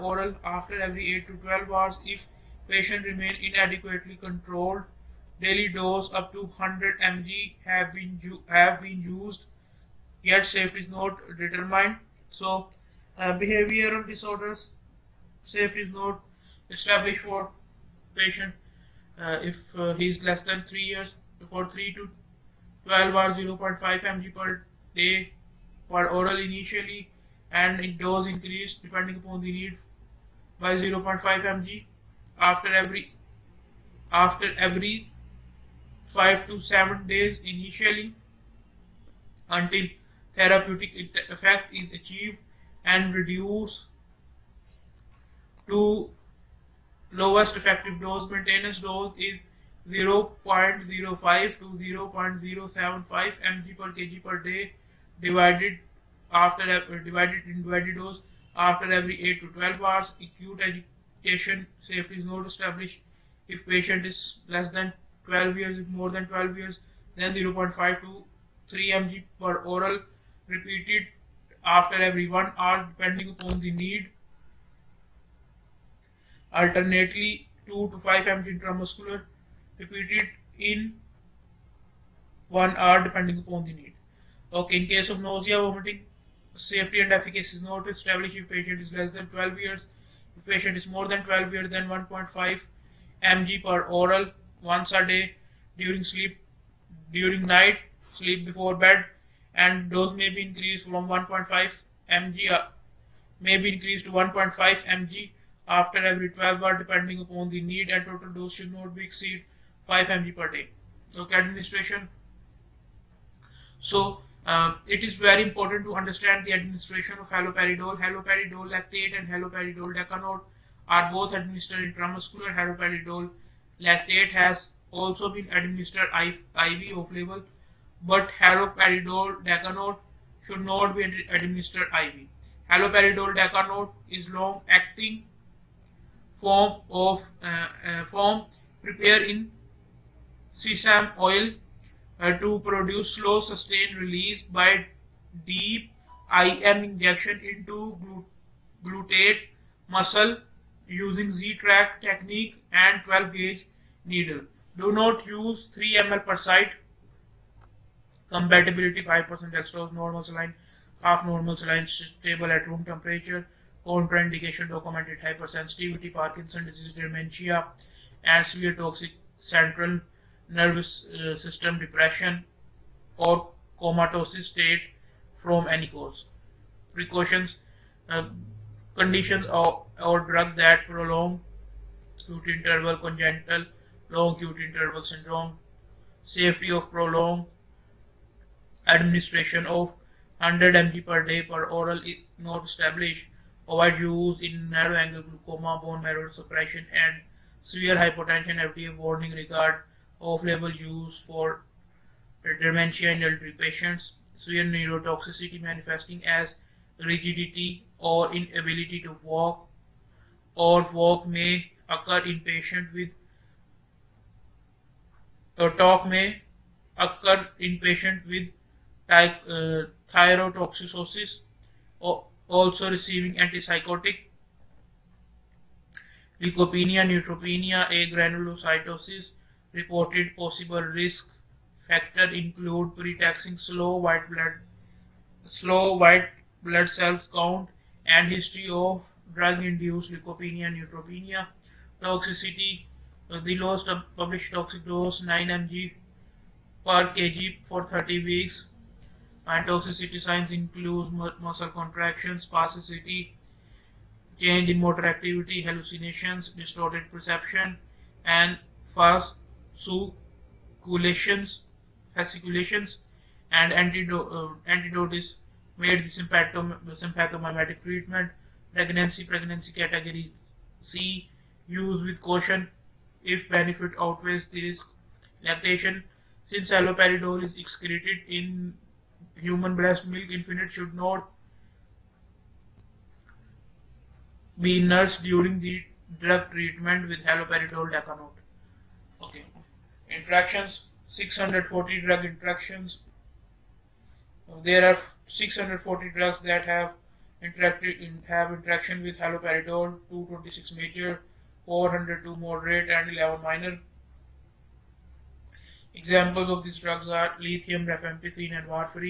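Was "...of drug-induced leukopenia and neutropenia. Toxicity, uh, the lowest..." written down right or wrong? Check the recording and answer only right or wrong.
right.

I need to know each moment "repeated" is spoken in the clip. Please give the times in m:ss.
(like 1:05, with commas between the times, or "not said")
1:10, 1:19.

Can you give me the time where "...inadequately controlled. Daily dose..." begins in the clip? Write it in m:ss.
0:03.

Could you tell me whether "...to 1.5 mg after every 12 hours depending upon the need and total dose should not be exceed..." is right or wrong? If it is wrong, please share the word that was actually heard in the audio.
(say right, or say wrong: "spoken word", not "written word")
right.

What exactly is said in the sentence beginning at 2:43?
Contraindication documented hypersensitivity, Parkinson disease, dementia, and severe toxic central nervous uh, system depression or comatose state from any cause.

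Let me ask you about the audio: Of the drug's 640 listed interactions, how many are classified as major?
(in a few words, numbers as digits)
226.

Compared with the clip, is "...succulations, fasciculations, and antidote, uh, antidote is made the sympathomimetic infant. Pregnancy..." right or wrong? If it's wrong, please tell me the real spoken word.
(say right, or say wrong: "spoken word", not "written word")
wrong: "treatment", not "infant".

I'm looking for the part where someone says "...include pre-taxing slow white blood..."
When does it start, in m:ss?
3:52.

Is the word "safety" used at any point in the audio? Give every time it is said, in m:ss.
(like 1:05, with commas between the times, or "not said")
0:10, 0:15, 1:01, 1:26, 3:06.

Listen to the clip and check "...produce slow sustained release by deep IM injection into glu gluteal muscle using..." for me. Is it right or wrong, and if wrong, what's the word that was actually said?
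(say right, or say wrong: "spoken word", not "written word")
right.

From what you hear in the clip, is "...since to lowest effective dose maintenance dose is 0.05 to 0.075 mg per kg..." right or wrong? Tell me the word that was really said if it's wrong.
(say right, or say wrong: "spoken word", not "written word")
wrong: "reduce", not "since".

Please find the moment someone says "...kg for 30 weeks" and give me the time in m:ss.
4:07.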